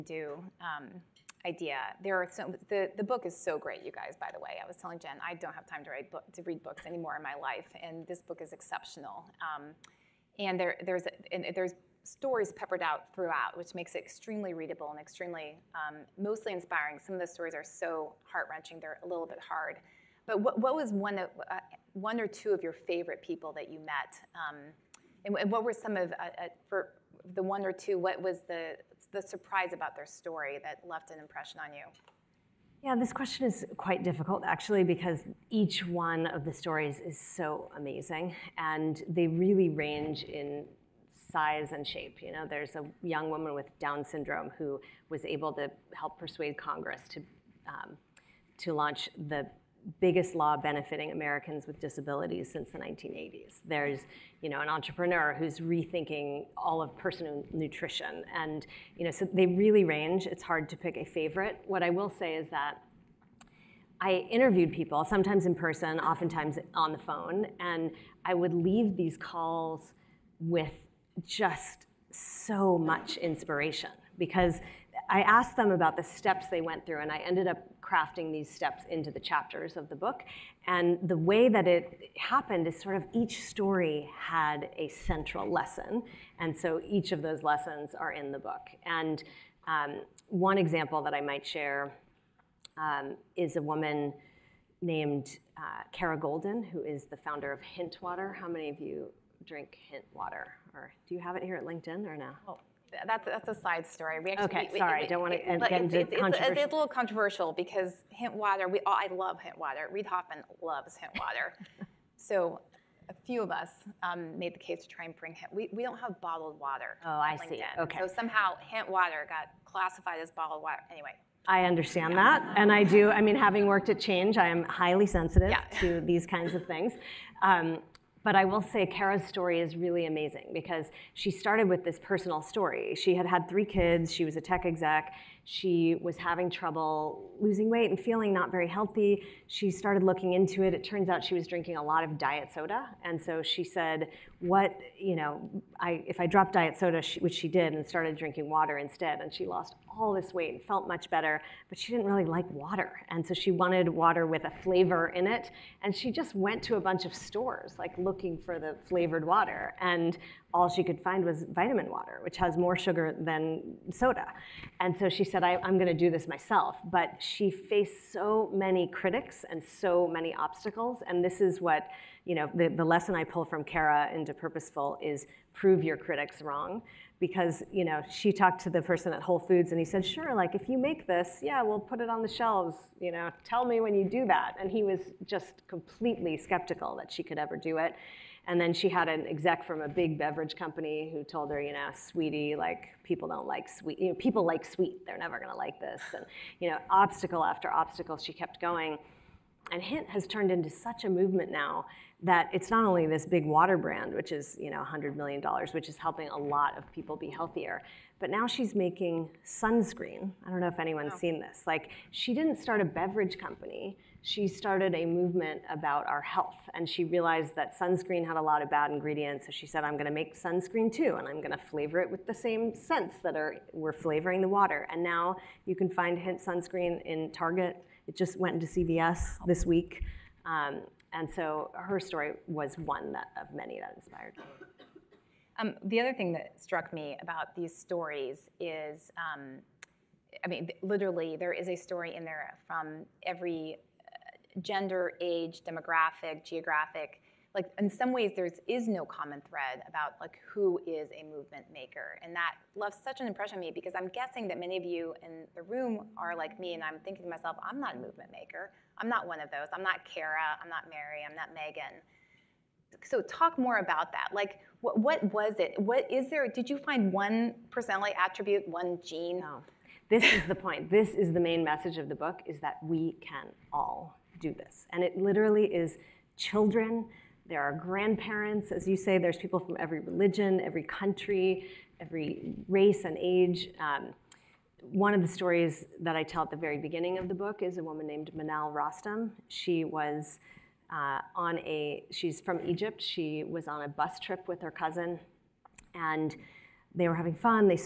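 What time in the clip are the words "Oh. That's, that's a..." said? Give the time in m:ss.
1:42.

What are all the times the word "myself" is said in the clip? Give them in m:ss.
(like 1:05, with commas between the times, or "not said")
2:46, 4:17.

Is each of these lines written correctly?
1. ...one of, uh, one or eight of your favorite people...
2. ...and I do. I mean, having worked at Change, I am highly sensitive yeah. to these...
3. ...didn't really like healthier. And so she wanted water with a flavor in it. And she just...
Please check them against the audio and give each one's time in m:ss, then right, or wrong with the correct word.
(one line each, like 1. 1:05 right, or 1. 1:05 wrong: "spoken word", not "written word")
1. 0:20 wrong: "two", not "eight"
2. 2:02 right
3. 2:31 wrong: "water", not "healthier".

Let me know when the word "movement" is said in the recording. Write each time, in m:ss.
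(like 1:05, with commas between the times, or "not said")
3:21, 3:35, 4:11, 4:17.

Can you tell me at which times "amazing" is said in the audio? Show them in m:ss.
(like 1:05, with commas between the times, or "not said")
0:37, 2:10.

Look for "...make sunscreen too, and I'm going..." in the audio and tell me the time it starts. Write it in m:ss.
3:40.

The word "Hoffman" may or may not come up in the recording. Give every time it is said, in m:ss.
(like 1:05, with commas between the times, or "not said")
1:50.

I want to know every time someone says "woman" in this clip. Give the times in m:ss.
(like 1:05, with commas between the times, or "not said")
0:43, 1:33, 4:47.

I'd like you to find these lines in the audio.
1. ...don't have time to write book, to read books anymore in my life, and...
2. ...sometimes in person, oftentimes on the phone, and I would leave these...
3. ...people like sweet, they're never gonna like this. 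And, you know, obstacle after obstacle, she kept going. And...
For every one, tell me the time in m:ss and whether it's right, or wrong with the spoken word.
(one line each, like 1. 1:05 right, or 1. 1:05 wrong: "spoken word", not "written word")
1. 0:05 right
2. 1:05 right
3. 3:14 right.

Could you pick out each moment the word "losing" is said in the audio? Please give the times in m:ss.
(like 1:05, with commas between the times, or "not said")
2:17.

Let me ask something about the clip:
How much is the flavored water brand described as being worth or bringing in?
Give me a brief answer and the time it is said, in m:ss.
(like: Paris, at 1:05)
$100 million, at 3:24.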